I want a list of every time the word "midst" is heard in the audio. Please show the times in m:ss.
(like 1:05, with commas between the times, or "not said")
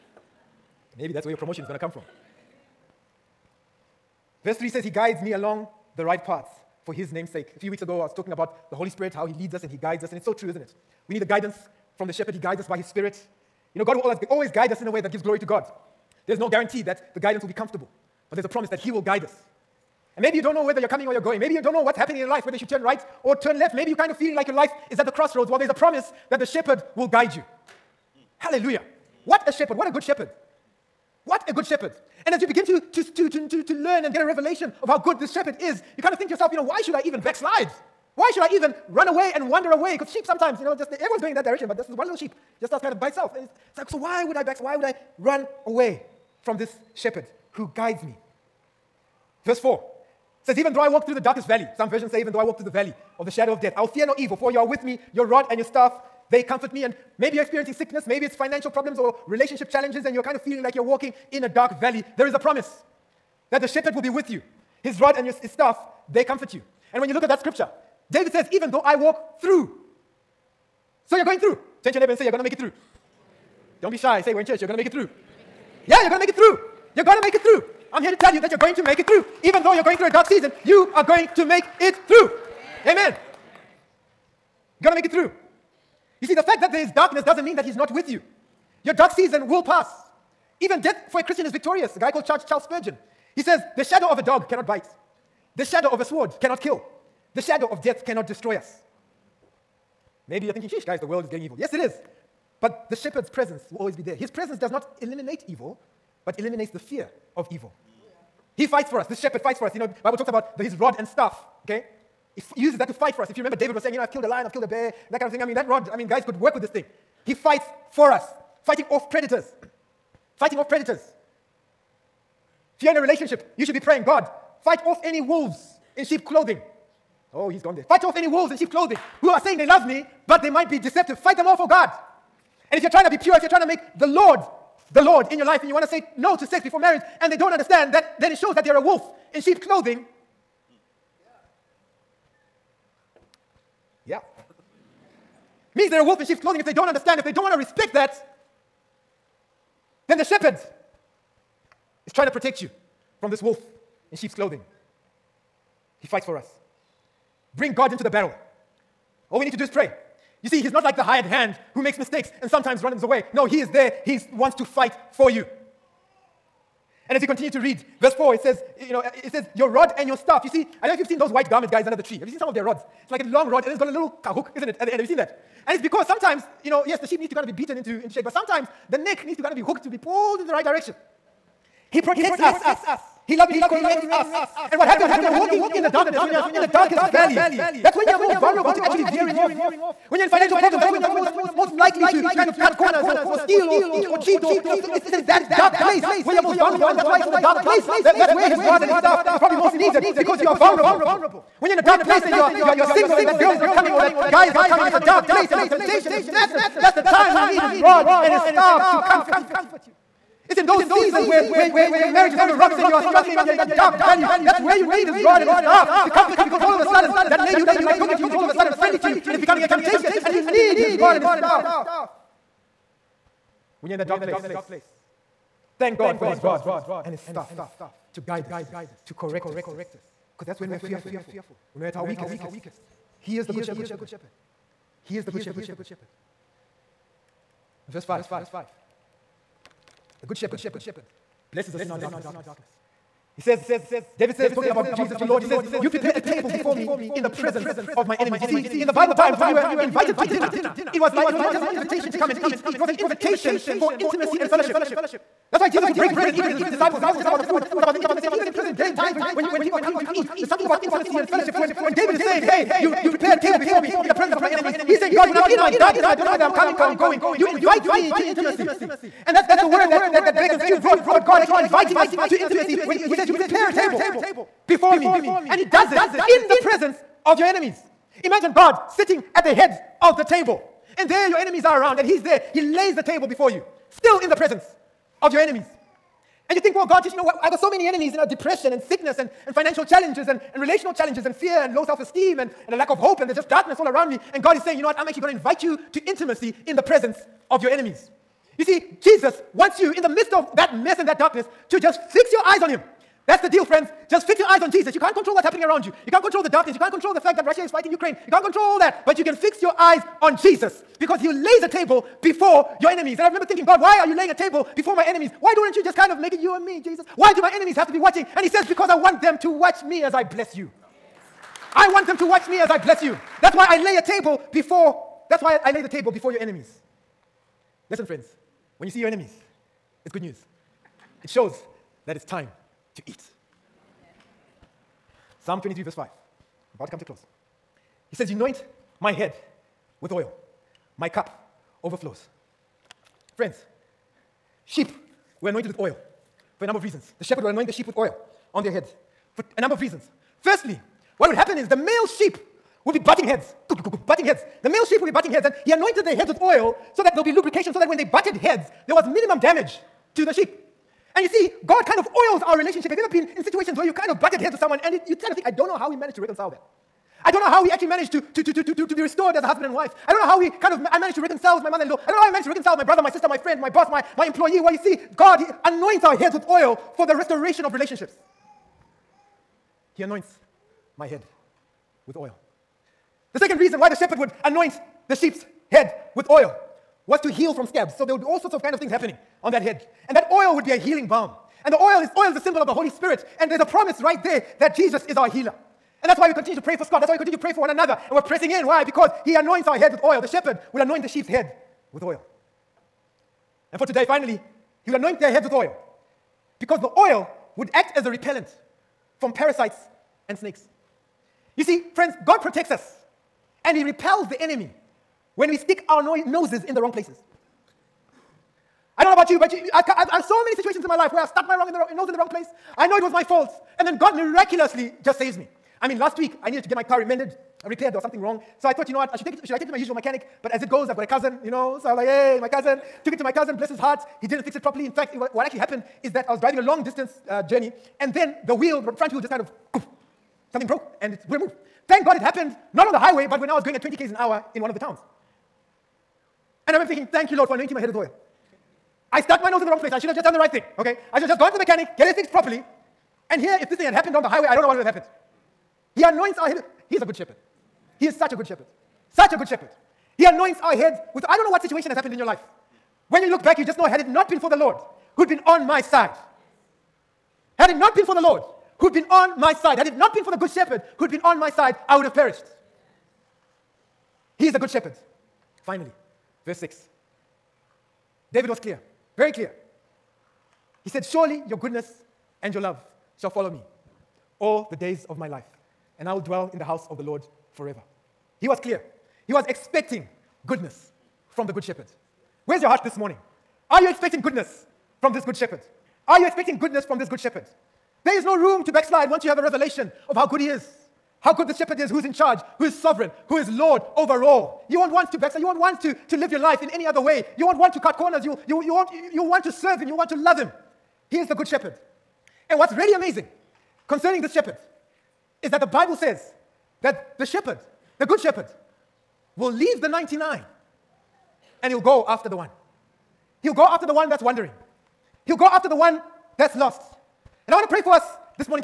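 5:00.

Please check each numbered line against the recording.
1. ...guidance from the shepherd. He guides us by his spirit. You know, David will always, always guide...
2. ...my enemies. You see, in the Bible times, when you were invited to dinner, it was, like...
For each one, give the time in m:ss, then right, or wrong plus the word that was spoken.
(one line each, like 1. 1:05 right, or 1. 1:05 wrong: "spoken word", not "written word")
1. 0:11 wrong: "God", not "David"
2. 4:08 right.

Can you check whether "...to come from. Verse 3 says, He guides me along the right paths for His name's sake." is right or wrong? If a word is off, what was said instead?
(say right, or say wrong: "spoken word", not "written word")
right.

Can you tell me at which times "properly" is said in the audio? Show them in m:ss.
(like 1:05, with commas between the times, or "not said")
7:14, 7:32.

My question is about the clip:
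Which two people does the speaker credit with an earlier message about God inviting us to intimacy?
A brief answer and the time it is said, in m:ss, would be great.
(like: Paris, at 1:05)
Beck and Stu, at 4:30.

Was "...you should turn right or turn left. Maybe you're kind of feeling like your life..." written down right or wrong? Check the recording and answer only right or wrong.
right.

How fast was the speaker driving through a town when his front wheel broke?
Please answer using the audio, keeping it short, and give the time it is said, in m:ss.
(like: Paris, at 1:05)
20 km/h, at 7:23.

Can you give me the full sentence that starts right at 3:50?
Because that's when we are fearful, when we're at our weakest.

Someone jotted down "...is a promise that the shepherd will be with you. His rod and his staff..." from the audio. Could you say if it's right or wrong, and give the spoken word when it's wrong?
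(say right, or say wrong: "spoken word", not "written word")
right.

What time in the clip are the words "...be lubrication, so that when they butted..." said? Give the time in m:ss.
5:57.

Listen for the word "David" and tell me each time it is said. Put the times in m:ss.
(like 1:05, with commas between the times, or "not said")
1:08, 1:53, 4:04, 4:21, 7:58.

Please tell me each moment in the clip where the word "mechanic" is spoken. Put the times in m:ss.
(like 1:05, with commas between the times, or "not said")
7:09, 7:31.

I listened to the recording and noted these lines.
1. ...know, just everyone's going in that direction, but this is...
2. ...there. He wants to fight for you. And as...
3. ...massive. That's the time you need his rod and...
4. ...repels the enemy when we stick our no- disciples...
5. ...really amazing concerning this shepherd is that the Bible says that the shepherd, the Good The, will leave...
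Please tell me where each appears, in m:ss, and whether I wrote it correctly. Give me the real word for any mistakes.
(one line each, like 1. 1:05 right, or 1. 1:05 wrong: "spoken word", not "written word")
1. 0:40 right
2. 2:43 right
3. 3:26 right
4. 6:53 wrong: "noses", not "disciples"
5. 8:32 wrong: "Shepherd", not "The".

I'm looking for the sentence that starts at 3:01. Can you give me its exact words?
He protects us, He lovingly corrects us.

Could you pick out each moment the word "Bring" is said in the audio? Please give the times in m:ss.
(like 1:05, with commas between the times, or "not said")
2:37.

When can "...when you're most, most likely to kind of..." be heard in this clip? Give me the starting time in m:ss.
3:10.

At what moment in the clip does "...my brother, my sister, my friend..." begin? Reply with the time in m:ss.
6:12.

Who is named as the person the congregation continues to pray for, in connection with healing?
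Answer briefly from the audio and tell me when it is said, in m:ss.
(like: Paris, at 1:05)
Scott, at 6:36.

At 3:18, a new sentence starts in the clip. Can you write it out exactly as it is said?
That, that's where his rod and his staff is probably most needed because you are vulnerable.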